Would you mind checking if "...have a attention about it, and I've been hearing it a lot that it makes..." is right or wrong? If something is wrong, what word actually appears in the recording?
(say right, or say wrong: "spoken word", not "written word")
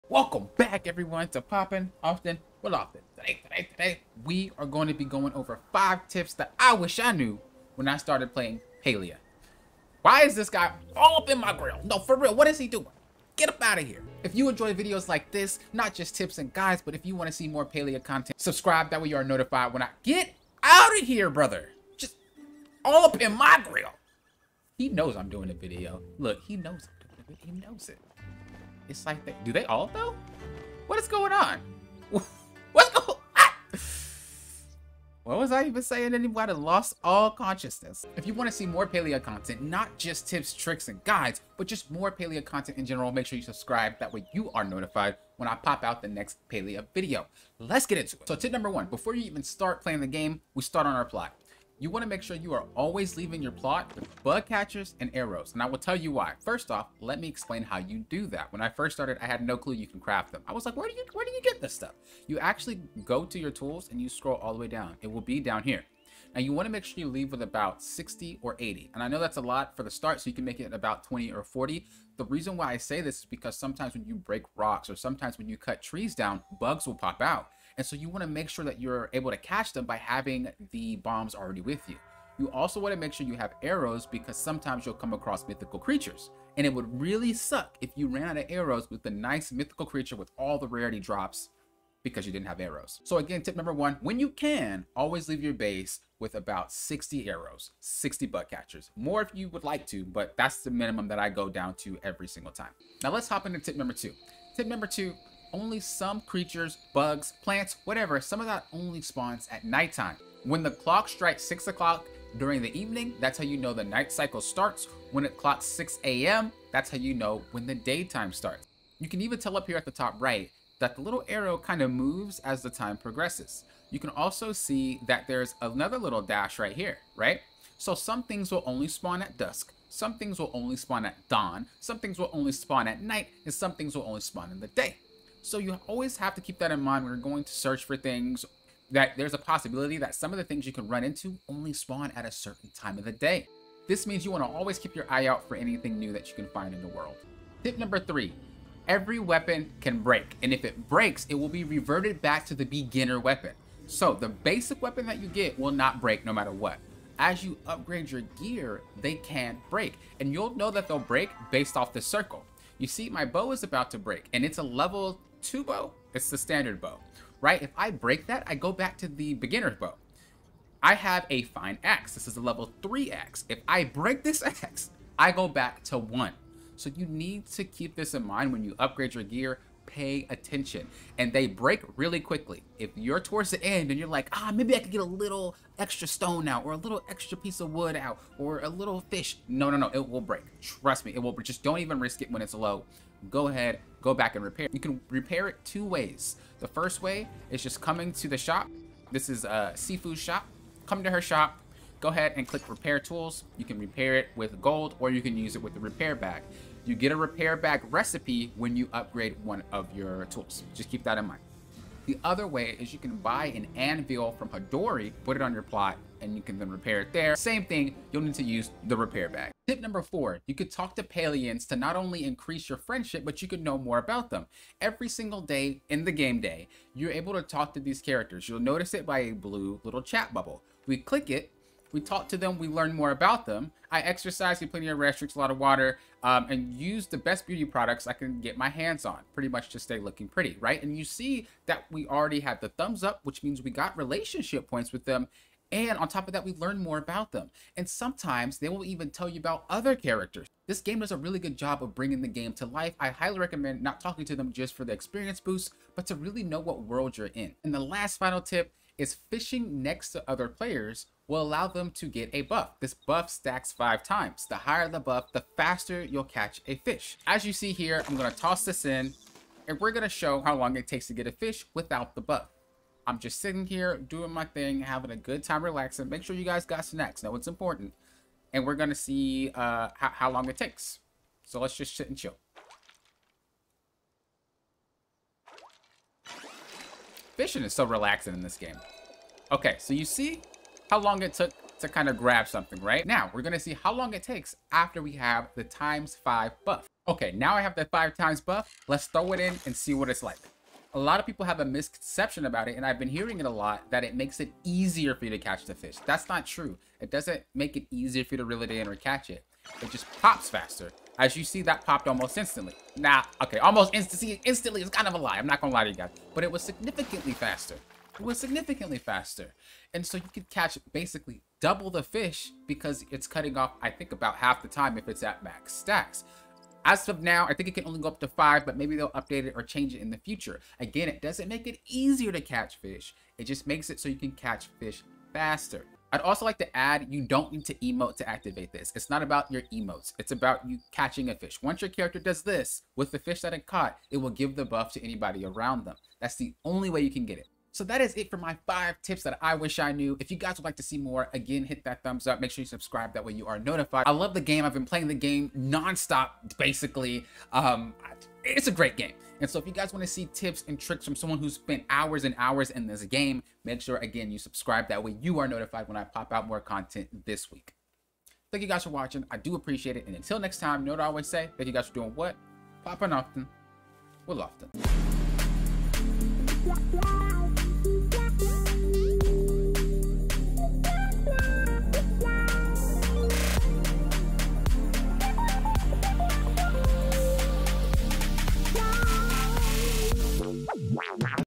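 wrong: "misconception", not "attention".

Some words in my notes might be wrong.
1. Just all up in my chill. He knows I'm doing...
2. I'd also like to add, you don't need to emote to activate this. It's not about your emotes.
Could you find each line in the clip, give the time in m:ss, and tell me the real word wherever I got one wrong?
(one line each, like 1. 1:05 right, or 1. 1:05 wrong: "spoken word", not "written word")
1. 0:21 wrong: "grill", not "chill"
2. 5:36 right.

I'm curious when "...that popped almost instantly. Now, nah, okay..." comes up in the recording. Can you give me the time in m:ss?
5:11.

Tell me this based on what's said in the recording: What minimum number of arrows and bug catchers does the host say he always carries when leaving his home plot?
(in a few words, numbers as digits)
60.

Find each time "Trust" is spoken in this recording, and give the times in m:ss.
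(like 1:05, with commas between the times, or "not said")
3:10.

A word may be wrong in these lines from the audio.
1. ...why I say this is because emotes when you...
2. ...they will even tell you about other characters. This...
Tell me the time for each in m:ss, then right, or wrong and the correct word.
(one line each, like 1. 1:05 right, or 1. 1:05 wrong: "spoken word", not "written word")
1. 1:12 wrong: "sometimes", not "emotes"
2. 4:08 right.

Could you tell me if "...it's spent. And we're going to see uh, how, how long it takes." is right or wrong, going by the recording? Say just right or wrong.
wrong.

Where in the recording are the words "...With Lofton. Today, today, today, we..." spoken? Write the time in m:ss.
0:02.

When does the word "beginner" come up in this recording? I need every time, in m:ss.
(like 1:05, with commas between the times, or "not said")
2:32, 2:49.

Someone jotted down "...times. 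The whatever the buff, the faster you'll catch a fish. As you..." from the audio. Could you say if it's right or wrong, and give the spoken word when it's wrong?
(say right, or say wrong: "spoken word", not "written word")
wrong: "higher", not "whatever".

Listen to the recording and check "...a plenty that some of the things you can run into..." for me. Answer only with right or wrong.
wrong.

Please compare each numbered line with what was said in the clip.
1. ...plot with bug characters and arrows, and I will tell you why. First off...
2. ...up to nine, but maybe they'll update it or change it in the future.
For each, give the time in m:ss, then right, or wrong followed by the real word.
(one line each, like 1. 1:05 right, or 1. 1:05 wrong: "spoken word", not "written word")
1. 0:53 wrong: "catchers", not "characters"
2. 5:28 wrong: "five", not "nine".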